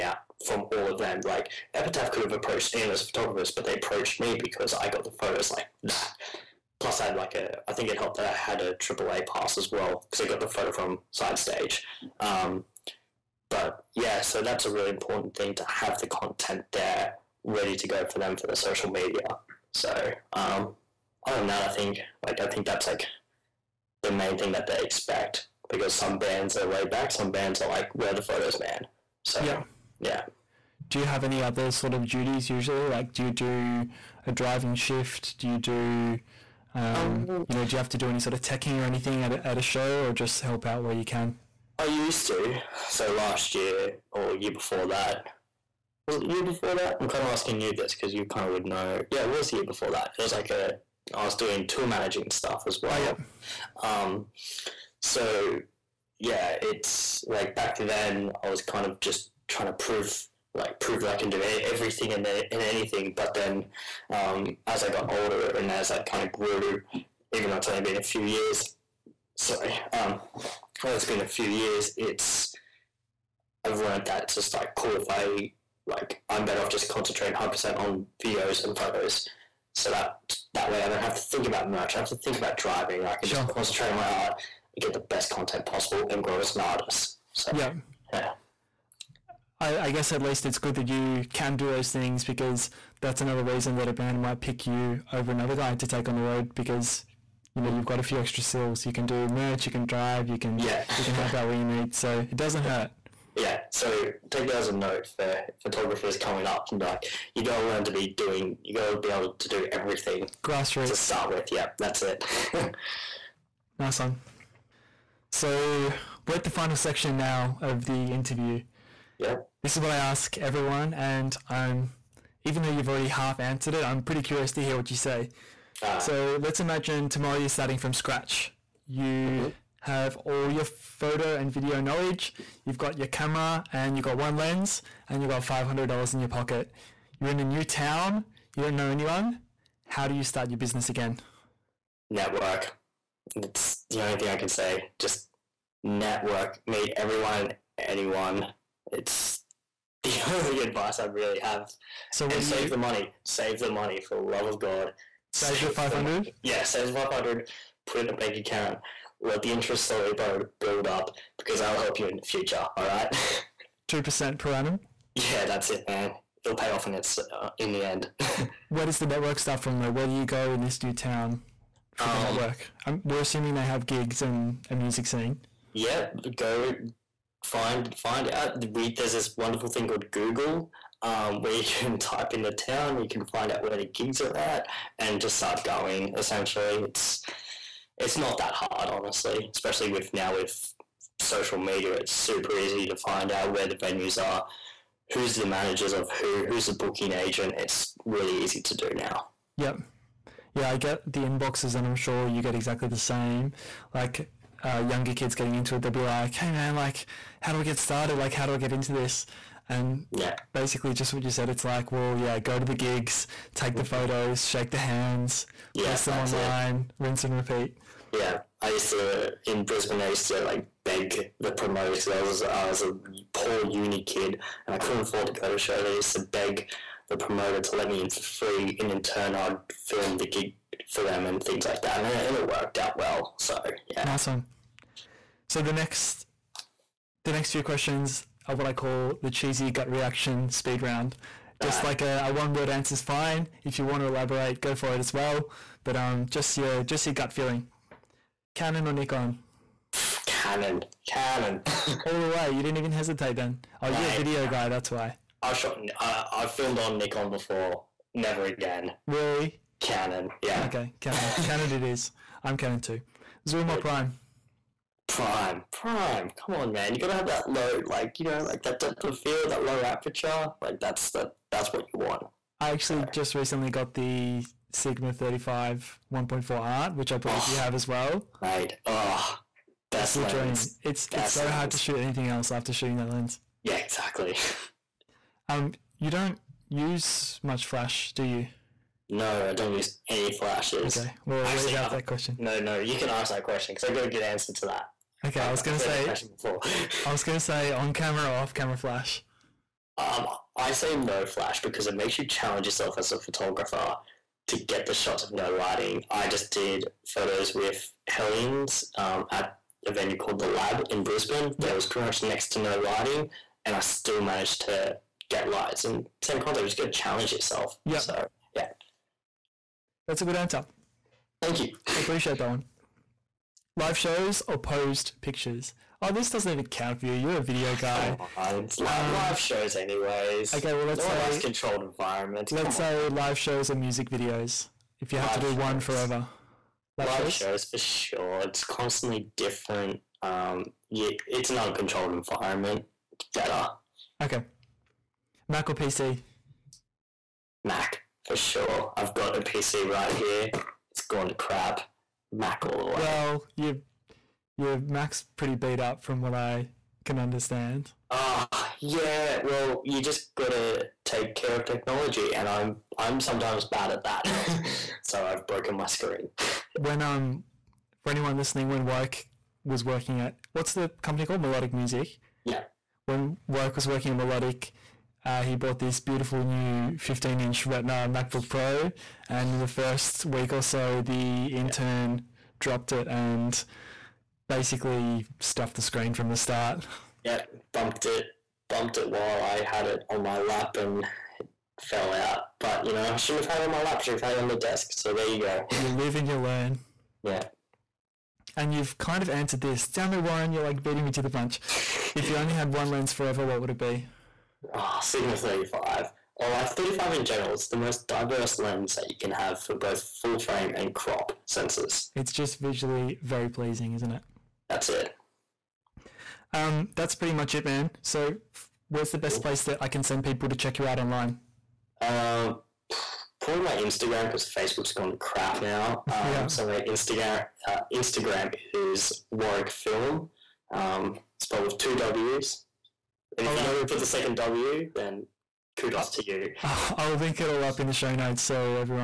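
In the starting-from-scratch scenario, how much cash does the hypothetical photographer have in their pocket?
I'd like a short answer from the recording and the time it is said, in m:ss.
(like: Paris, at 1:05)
$500, at 2:15.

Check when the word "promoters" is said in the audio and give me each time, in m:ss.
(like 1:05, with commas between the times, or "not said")
3:41, 3:47.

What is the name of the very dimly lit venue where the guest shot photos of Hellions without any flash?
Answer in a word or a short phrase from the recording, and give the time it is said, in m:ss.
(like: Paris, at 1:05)
the Lab, at 5:10.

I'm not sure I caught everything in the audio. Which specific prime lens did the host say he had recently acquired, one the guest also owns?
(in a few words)
Sigma 35 1.4 Art.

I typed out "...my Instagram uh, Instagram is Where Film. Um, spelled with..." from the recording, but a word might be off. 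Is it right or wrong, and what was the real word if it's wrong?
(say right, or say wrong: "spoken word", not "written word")
wrong: "Warwick", not "Where".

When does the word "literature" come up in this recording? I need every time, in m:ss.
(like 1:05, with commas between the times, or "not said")
not said.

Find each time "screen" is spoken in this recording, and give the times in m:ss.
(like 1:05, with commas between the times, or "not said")
6:05, 6:25.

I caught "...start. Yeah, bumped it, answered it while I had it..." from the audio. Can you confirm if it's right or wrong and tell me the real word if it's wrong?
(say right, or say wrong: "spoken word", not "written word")
wrong: "bumped", not "answered".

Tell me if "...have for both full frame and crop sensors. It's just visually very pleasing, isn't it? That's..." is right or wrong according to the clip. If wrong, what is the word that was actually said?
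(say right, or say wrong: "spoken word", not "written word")
right.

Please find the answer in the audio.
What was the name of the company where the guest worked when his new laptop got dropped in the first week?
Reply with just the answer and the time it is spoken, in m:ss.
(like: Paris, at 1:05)
Melodic Music, at 6:11.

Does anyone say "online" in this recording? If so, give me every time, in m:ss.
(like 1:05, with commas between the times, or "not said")
3:36, 7:00.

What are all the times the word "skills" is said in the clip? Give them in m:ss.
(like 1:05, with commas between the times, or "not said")
1:38.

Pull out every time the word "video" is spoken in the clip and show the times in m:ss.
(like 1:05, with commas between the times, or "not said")
1:18, 2:11, 4:14, 5:27, 5:34.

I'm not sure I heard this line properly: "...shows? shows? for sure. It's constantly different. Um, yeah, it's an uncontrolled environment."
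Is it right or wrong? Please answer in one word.
right.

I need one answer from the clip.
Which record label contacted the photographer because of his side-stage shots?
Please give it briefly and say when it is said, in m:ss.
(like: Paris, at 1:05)
Epitaph, at 0:01.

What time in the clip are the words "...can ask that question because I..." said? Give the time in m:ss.
4:52.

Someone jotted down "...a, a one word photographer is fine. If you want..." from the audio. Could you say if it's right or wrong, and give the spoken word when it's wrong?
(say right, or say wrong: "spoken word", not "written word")
wrong: "answer", not "photographer".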